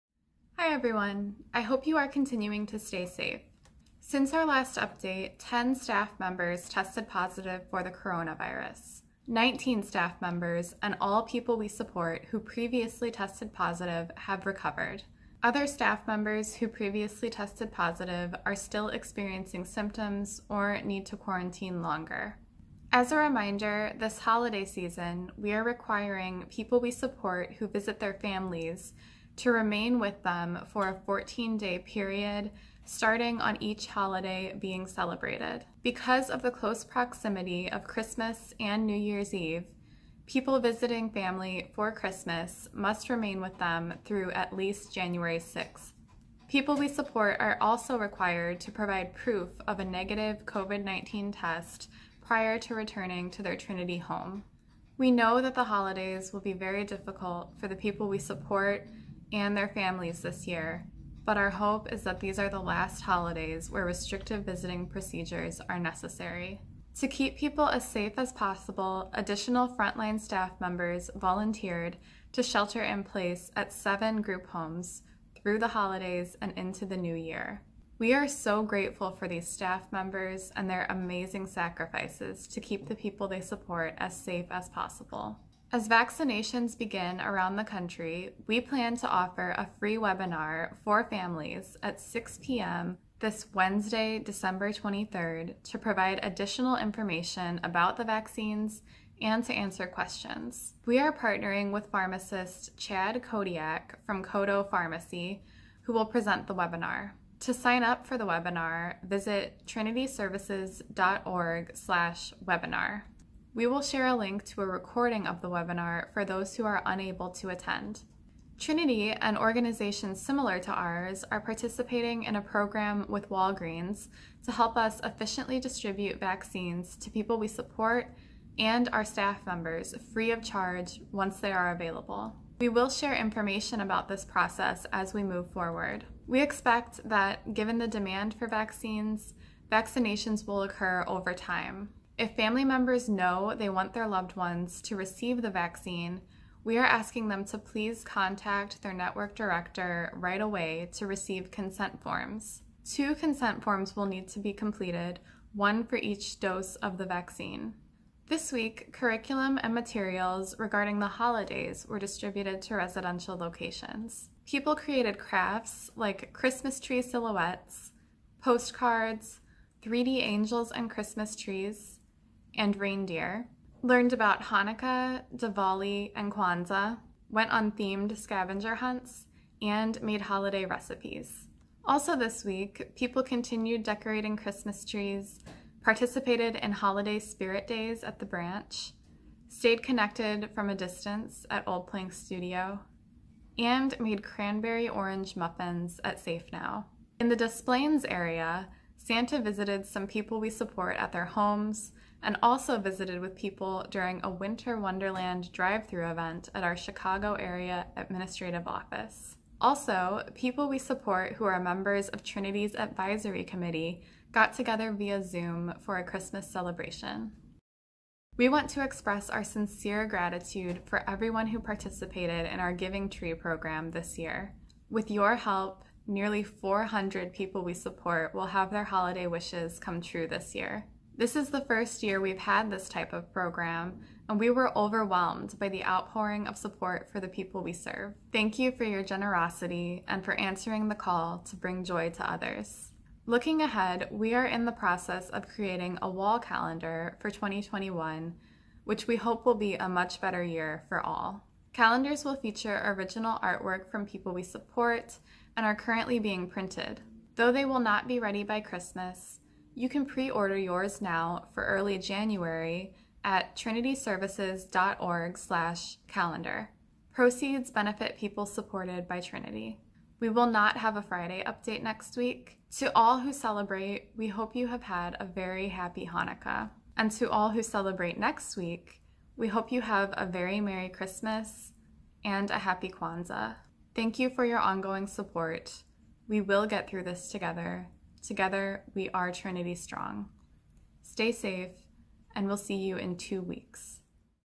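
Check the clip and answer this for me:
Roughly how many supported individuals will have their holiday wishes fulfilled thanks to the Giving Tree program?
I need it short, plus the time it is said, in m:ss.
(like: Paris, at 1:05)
nearly 400, at 3:46.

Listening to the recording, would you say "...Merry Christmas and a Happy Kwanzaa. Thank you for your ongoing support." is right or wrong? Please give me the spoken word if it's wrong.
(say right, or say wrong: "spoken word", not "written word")
right.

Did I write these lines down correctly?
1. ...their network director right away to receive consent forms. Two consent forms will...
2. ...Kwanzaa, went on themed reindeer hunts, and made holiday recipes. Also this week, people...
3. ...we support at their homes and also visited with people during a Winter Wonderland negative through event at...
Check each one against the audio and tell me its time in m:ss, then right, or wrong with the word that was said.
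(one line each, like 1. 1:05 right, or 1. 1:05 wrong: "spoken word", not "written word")
1. 2:28 right
2. 2:56 wrong: "scavenger", not "reindeer"
3. 3:20 wrong: "drive", not "negative".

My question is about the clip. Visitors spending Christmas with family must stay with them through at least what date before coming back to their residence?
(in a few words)
January 6th.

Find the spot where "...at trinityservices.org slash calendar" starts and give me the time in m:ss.
4:23.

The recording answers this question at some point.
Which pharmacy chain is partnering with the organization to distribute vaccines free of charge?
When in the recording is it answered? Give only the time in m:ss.
2:03.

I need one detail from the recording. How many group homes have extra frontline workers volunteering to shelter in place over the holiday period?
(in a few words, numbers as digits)
7.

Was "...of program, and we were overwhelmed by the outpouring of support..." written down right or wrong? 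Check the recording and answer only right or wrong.
right.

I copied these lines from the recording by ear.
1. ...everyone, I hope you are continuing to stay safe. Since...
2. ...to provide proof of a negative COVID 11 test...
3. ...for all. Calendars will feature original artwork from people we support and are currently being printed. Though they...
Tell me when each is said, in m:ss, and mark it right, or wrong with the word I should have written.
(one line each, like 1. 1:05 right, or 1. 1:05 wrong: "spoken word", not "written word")
1. 0:00 right
2. 0:48 wrong: "19", not "11"
3. 4:10 right.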